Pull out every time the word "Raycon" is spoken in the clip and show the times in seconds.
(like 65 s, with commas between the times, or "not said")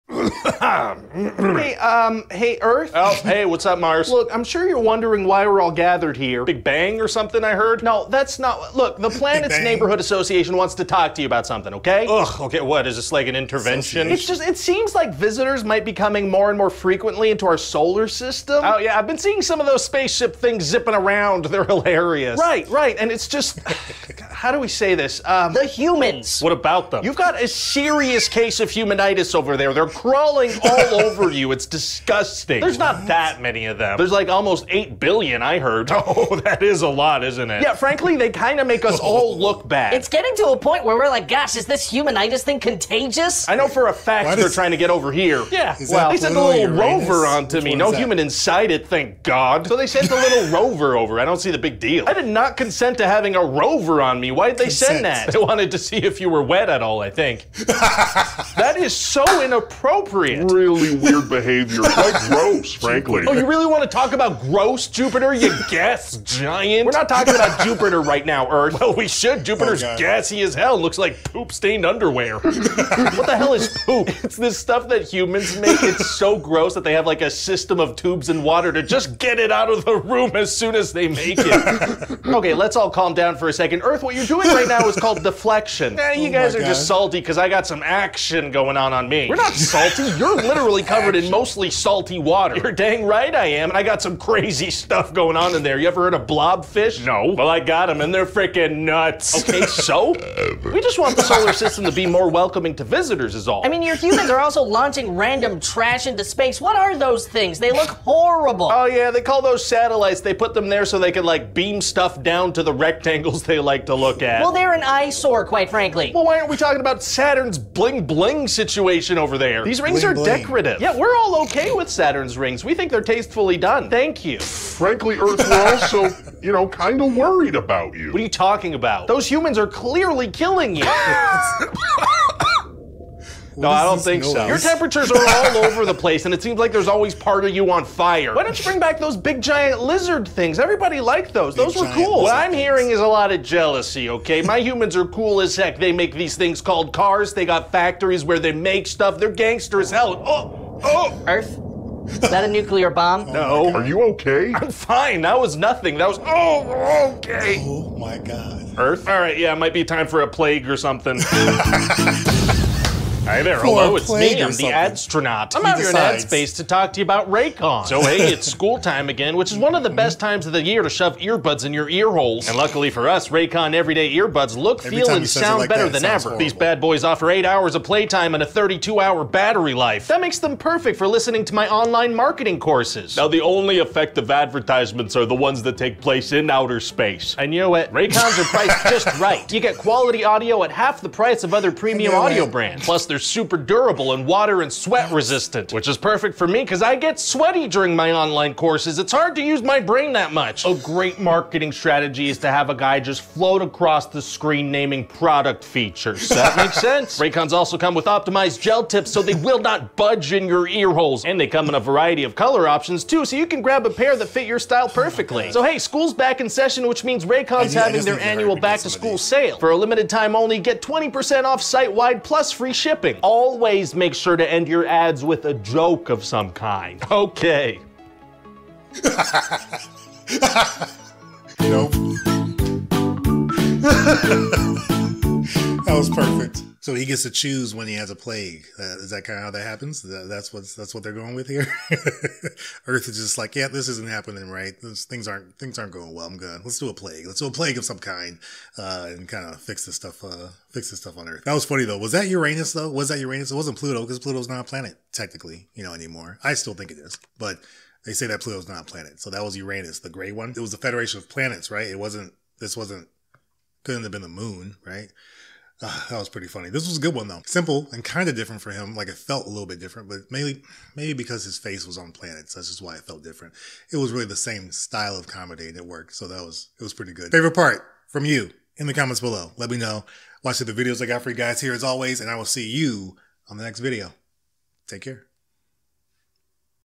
167 s, 173 s, 187 s, 207 s, 217 s.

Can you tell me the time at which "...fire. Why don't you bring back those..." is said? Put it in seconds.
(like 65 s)
137 s.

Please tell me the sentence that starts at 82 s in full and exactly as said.
okay, let's all calm down for a second.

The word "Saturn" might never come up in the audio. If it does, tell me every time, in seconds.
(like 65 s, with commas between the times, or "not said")
117 s, 121 s.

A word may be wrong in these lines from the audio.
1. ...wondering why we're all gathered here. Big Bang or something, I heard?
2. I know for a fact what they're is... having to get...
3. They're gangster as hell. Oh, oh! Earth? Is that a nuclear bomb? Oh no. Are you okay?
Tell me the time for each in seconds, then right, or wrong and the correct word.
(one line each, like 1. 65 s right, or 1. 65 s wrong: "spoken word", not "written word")
1. 4 s right
2. 43 s wrong: "trying", not "having"
3. 149 s right.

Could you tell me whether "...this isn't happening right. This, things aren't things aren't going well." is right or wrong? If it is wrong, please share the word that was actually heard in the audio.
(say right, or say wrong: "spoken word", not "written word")
right.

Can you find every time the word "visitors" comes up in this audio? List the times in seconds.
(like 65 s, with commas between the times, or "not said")
15 s, 102 s.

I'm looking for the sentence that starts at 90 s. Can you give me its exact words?
You're literally covered in mostly salty water.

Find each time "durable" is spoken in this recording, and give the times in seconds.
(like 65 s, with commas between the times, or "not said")
193 s.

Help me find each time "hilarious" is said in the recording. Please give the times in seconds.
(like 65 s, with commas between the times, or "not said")
21 s.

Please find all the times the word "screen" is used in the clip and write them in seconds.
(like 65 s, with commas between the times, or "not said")
204 s.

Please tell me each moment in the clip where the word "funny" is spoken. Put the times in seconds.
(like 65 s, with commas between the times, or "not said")
251 s, 266 s.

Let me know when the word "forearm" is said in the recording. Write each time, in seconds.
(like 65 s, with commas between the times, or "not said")
not said.